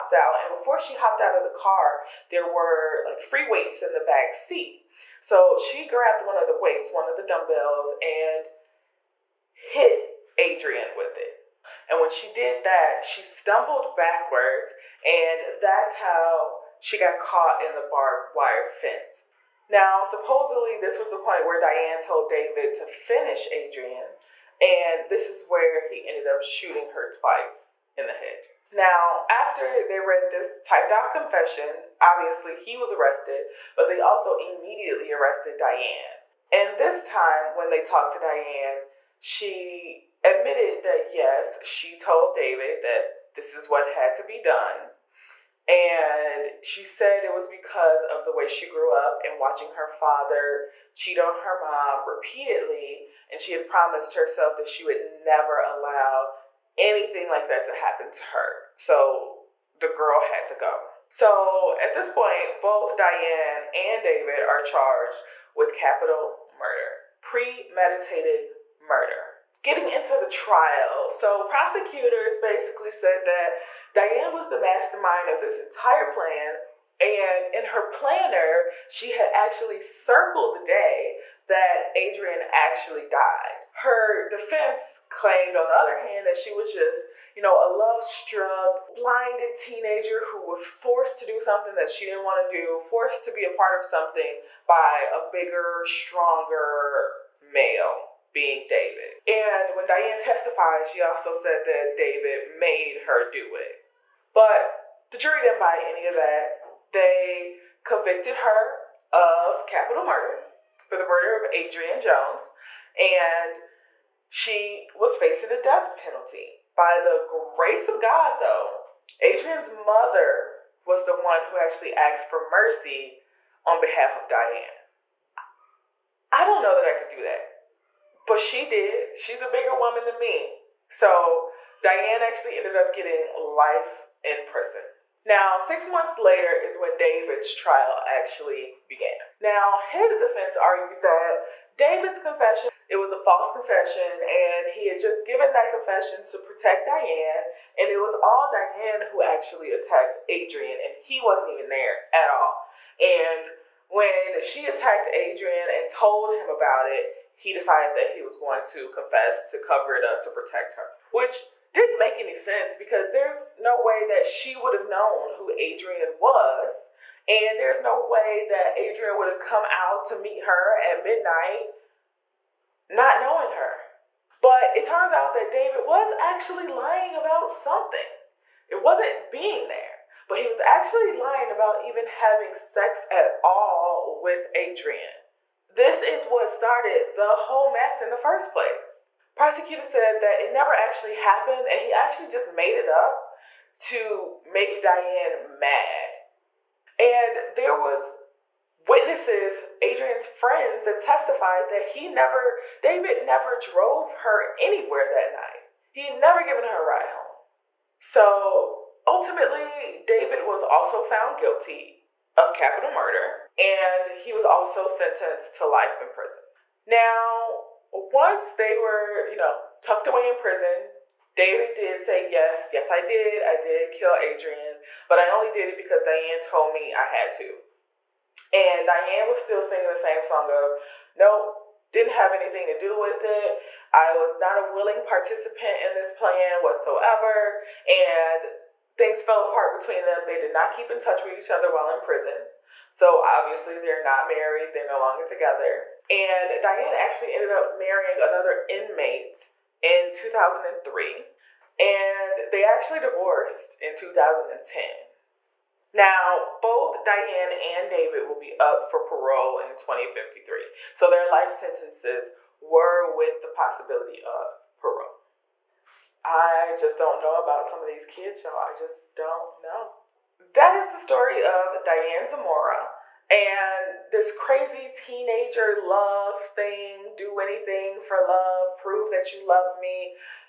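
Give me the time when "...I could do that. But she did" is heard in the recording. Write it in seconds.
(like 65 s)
126 s.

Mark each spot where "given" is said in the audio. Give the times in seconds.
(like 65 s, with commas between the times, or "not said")
145 s, 206 s.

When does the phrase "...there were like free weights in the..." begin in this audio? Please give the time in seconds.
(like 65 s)
2 s.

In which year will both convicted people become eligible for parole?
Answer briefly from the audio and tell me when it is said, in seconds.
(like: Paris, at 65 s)
2053, at 259 s.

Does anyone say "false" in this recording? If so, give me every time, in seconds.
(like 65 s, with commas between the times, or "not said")
143 s.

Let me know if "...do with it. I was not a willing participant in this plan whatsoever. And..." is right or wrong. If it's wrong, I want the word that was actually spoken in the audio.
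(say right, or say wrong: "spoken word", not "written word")
right.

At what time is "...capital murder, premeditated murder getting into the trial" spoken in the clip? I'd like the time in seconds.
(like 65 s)
65 s.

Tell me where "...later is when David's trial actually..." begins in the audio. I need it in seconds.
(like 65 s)
136 s.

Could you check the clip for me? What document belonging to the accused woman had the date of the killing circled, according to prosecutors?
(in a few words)
her planner.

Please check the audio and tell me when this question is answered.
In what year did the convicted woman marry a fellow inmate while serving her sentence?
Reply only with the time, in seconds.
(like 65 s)
250 s.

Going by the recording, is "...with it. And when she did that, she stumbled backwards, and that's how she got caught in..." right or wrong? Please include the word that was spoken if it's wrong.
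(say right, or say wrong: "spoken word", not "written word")
right.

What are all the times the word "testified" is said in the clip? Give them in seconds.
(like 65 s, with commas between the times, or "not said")
100 s, 201 s.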